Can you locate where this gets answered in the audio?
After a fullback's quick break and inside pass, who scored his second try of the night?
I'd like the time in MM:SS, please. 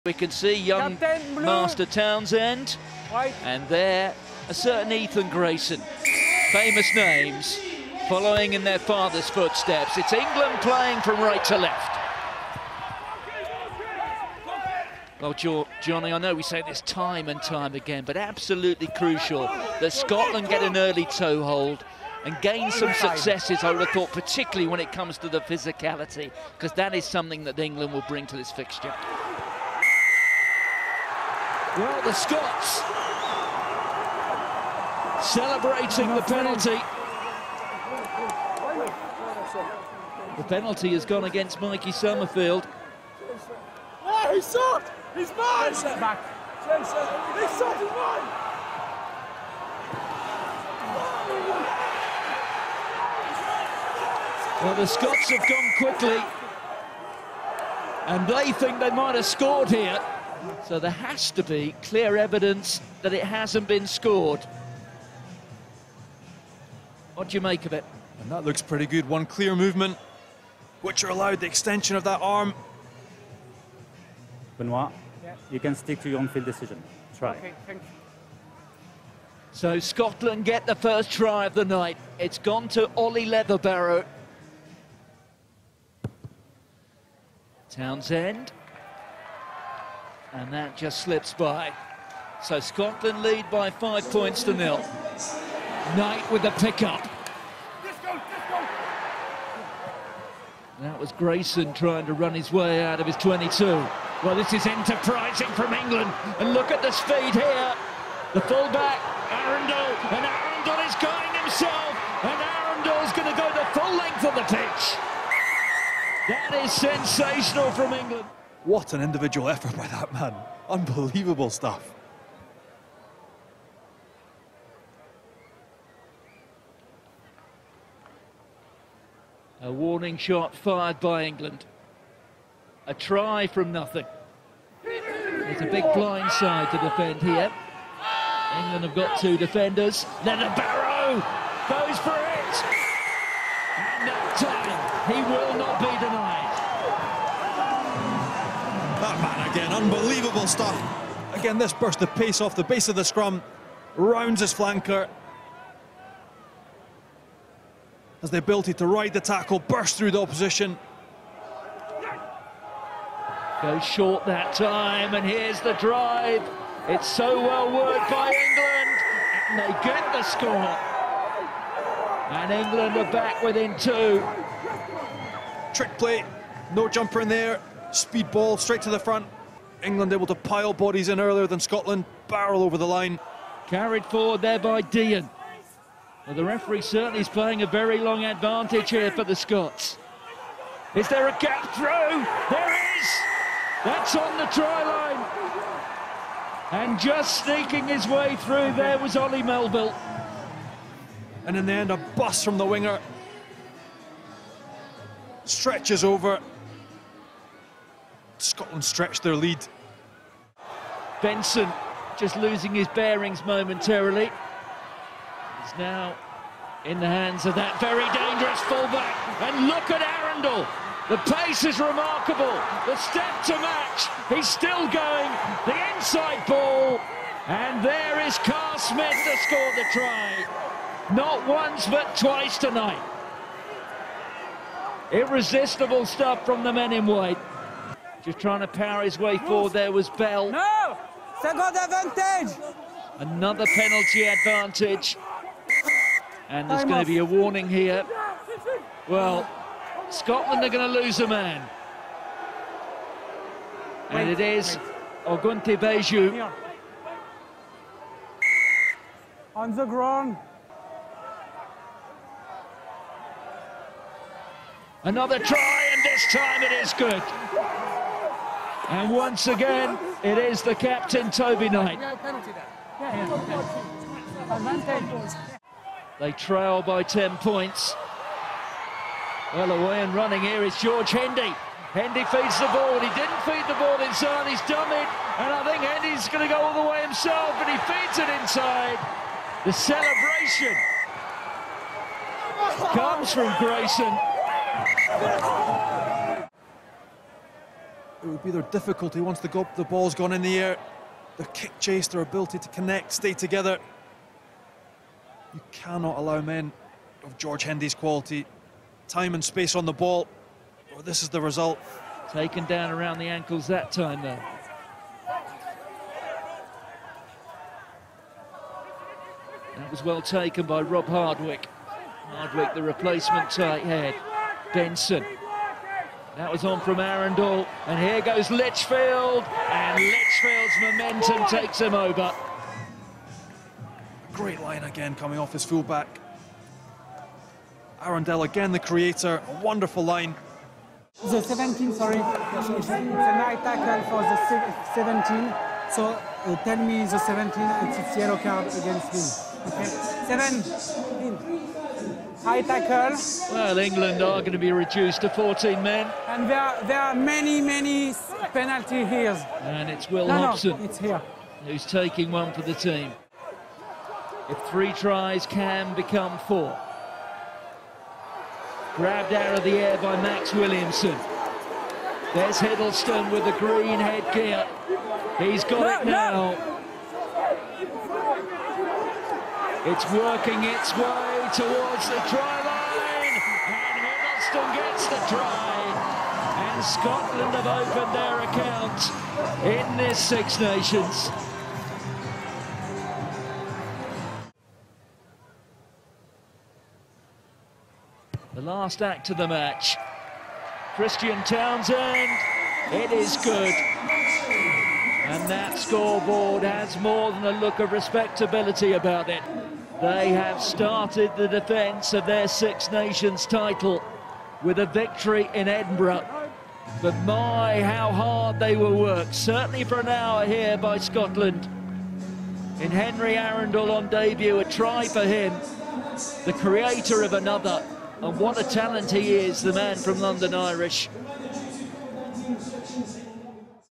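03:48.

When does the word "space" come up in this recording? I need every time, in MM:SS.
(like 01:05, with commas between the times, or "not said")
05:09.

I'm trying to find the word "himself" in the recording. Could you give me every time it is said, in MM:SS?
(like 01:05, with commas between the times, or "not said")
01:51, 04:47.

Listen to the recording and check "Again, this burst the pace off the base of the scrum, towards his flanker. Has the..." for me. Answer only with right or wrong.
wrong.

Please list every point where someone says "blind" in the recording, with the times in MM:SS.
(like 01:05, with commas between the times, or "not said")
02:15.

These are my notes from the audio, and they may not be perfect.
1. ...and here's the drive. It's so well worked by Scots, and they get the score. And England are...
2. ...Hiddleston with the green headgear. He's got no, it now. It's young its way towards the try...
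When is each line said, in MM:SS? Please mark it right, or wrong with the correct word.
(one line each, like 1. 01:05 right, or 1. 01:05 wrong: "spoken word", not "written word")
1. 02:45 wrong: "England", not "Scots"
2. 06:12 wrong: "working", not "young".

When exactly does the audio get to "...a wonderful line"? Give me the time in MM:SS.
05:39.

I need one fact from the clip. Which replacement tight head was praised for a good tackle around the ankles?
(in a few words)
Rob Hardwick.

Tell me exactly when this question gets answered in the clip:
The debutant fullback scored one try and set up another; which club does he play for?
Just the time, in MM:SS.
07:10.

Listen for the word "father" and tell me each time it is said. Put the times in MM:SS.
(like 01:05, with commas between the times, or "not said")
00:08.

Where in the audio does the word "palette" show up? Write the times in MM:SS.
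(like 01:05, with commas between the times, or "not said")
not said.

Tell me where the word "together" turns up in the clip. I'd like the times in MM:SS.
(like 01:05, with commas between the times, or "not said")
05:03.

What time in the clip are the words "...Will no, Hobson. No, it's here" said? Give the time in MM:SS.
06:00.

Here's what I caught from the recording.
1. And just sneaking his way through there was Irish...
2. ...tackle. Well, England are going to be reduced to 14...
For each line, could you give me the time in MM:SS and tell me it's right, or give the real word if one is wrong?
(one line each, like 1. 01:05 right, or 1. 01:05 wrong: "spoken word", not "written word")
1. 03:16 wrong: "Ollie", not "Irish"
2. 05:52 right.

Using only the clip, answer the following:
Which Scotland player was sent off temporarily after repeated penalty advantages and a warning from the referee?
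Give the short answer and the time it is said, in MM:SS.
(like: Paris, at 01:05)
Ogunte Beju, at 04:15.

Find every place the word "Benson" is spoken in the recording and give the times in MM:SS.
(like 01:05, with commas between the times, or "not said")
03:31, 05:24.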